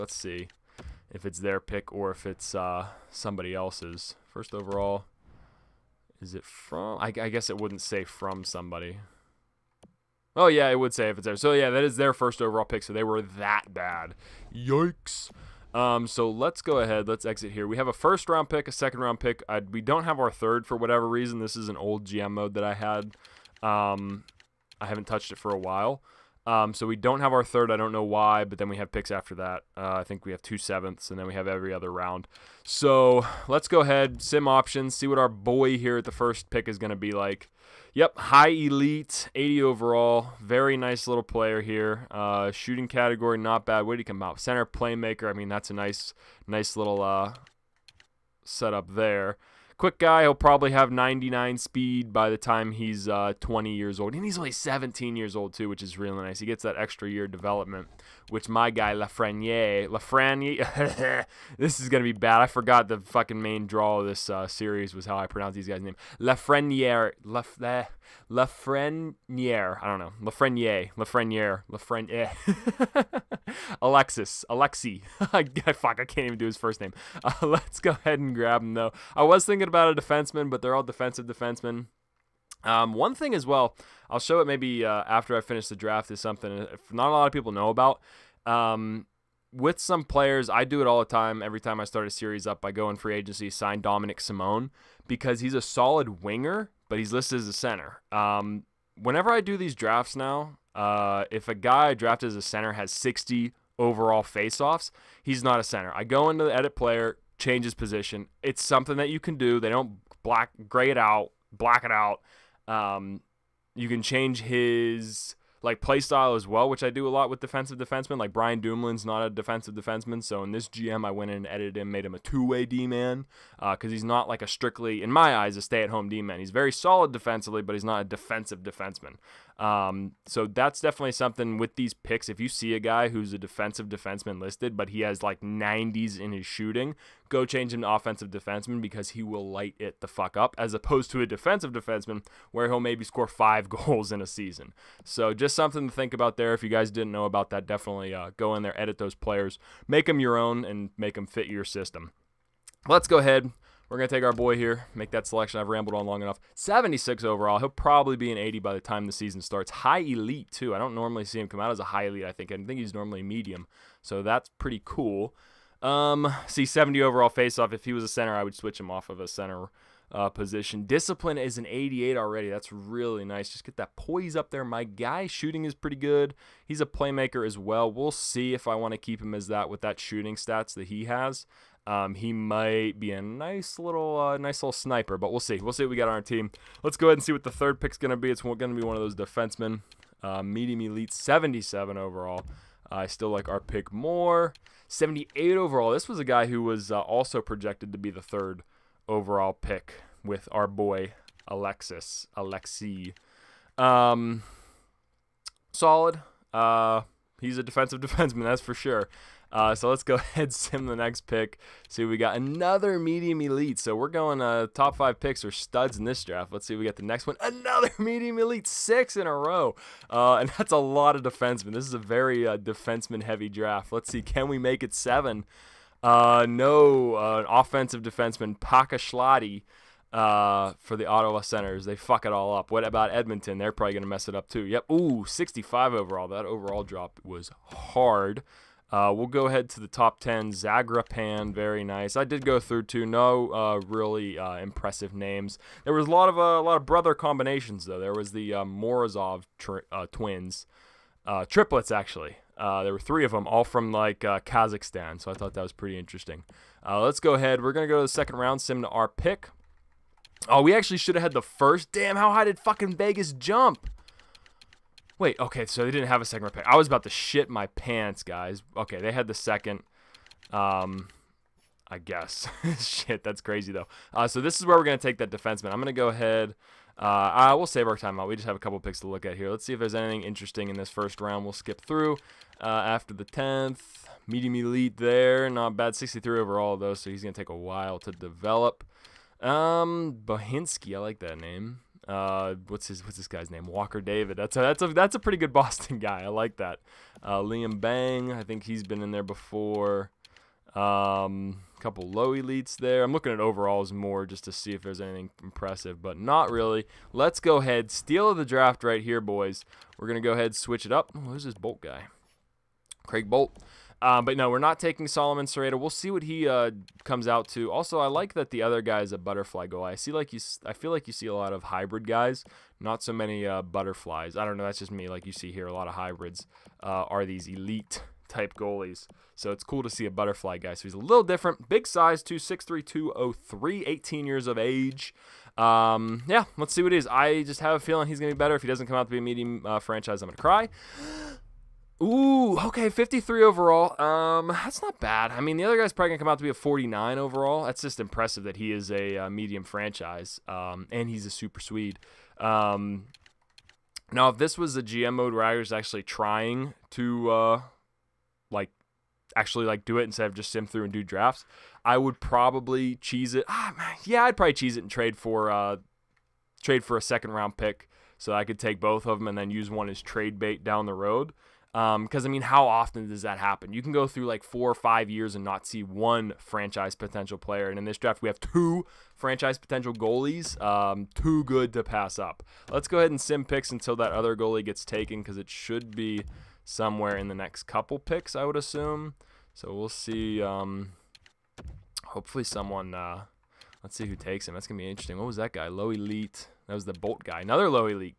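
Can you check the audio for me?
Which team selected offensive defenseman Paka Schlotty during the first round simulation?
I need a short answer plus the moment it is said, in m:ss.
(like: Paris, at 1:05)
Ottawa Senators, at 3:51.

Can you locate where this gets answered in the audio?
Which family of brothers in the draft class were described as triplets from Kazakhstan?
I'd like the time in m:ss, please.
4:08.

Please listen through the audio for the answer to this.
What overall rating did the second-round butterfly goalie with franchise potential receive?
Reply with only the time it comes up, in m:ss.
5:42.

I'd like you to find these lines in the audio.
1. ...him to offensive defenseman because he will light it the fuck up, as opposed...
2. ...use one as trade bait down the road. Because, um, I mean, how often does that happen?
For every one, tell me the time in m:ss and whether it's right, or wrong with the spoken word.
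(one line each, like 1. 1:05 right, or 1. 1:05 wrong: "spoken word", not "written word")
1. 2:17 right
2. 6:09 right.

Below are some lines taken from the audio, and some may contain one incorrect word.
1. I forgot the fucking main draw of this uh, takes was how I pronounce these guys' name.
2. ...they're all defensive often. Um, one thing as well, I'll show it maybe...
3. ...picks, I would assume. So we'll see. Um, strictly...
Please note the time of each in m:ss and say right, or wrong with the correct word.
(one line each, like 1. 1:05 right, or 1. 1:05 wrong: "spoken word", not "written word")
1. 1:02 wrong: "series", not "takes"
2. 1:20 wrong: "defensemen", not "often"
3. 6:27 wrong: "hopefully", not "strictly".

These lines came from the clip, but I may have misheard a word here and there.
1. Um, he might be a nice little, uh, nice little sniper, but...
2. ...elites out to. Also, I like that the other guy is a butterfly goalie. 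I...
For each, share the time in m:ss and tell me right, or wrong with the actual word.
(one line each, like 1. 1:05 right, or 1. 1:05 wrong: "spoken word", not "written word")
1. 3:01 right
2. 5:17 wrong: "comes", not "elites".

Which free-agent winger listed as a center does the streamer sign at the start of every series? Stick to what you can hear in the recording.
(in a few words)
Dominic Simone.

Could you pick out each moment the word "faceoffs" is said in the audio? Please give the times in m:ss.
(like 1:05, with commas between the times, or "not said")
1:44, 2:47.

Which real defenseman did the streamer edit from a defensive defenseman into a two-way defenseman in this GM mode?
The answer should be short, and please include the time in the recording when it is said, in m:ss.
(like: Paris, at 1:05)
Brian Dumoulin, at 1:58.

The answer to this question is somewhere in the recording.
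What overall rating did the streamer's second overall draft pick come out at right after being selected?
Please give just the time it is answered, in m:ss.
2:36.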